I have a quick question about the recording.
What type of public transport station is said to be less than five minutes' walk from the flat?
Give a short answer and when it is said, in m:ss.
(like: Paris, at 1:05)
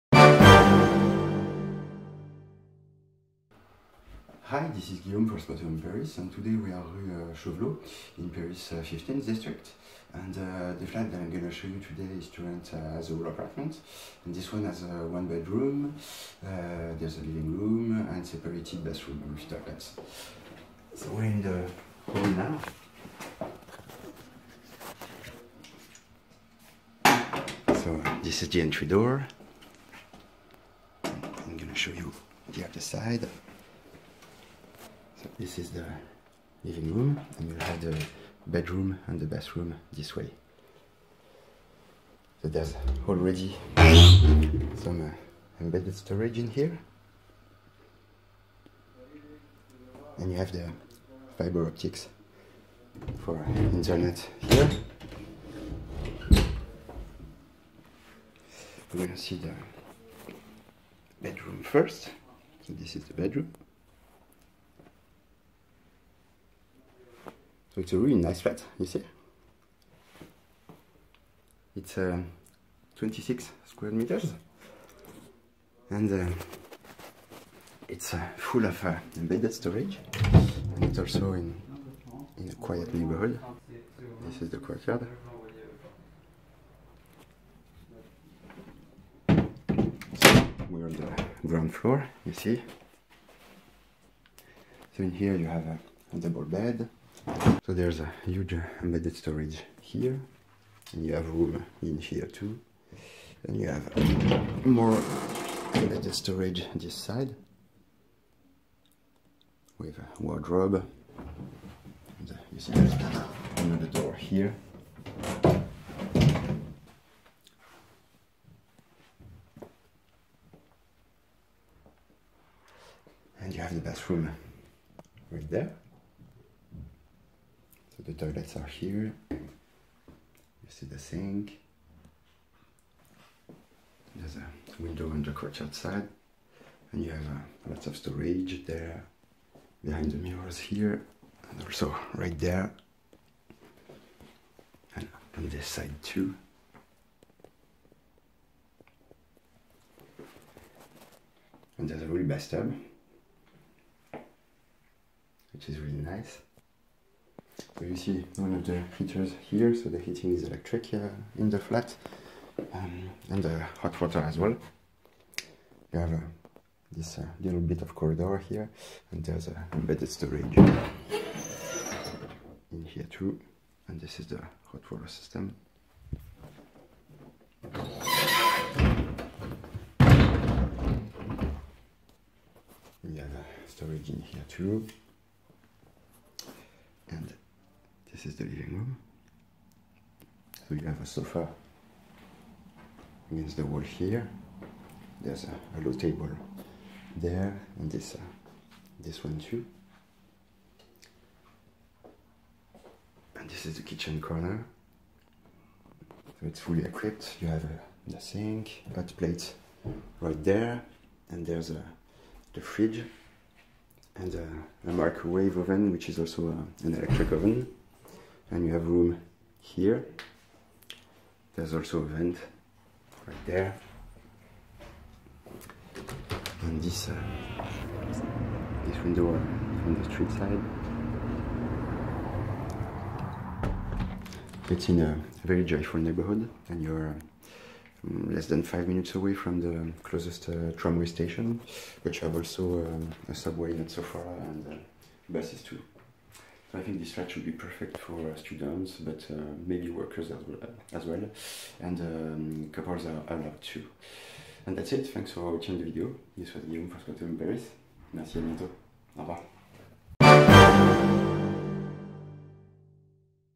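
Tramway station, at 4:00.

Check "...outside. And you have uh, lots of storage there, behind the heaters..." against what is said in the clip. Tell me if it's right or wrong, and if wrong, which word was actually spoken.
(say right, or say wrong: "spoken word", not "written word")
wrong: "mirrors", not "heaters".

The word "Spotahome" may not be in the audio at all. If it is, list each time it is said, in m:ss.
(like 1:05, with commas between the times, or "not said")
0:05, 4:16.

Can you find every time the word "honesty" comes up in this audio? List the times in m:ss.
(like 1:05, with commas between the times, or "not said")
not said.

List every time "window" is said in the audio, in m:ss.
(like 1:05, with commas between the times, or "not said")
2:14, 3:49.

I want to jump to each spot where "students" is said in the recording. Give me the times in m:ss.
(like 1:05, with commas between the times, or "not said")
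4:08.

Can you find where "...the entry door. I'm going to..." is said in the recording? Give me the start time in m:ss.
0:28.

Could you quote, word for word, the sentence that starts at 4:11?
and um, couples are allowed too.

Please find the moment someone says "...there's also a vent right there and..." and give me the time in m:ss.
3:41.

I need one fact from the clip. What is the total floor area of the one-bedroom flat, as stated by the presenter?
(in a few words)
26 square meters.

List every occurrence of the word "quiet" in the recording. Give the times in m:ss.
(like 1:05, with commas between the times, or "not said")
1:22.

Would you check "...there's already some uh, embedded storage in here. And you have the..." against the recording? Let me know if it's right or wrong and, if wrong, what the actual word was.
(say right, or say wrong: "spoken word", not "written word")
right.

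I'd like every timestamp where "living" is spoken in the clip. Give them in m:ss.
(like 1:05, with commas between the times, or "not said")
0:17, 0:36, 3:08.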